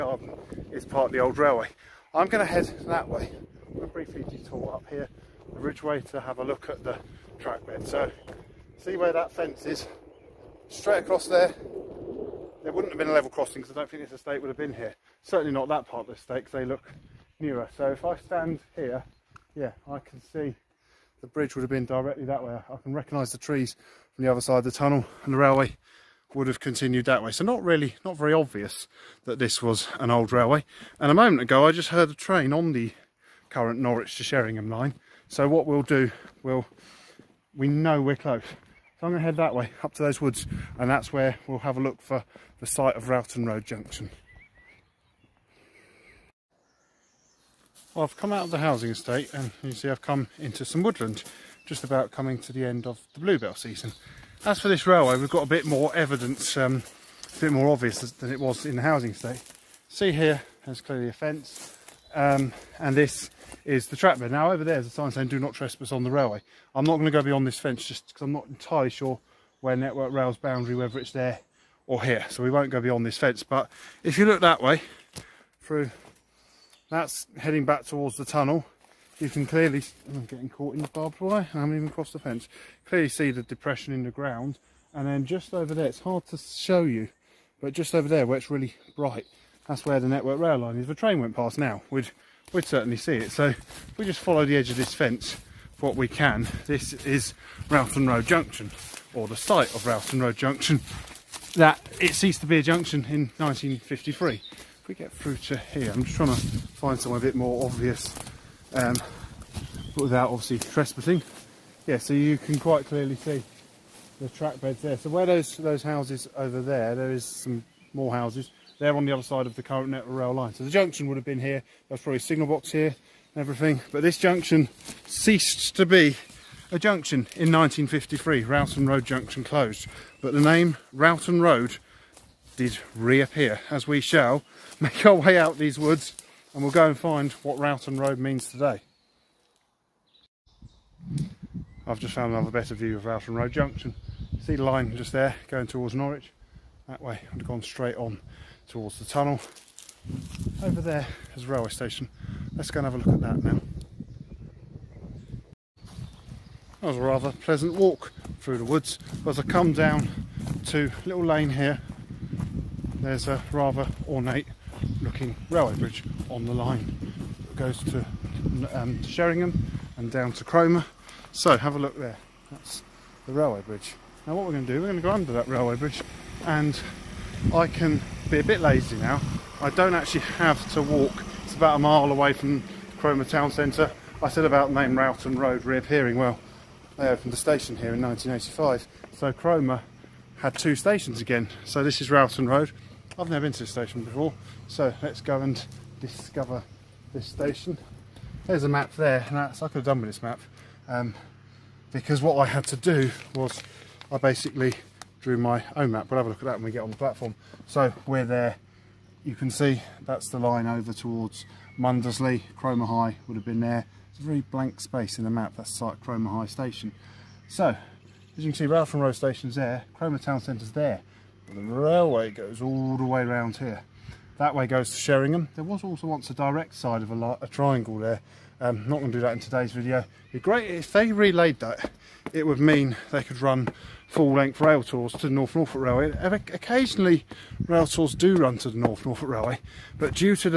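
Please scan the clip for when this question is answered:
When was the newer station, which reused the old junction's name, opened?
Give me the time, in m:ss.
3:07.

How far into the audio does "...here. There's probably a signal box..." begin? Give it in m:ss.
2:01.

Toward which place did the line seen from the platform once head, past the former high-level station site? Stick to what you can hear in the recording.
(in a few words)
Mundesley.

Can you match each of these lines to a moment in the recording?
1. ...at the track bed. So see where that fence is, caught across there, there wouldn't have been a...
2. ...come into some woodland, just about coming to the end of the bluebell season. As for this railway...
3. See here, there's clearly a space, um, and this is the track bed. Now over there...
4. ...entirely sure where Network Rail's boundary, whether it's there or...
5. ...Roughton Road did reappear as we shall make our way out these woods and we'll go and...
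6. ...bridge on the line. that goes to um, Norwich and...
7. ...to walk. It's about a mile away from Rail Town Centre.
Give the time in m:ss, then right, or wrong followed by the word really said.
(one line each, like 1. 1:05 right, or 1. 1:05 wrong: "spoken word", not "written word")
1. 0:06 wrong: "straight", not "caught"
2. 0:50 right
3. 0:59 wrong: "fence", not "space"
4. 1:08 right
5. 2:10 right
6. 2:45 wrong: "Sheringham", not "Norwich"
7. 3:00 wrong: "Cromer", not "Rail".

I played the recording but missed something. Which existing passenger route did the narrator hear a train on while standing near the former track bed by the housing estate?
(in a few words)
Norwich to Sheringham line.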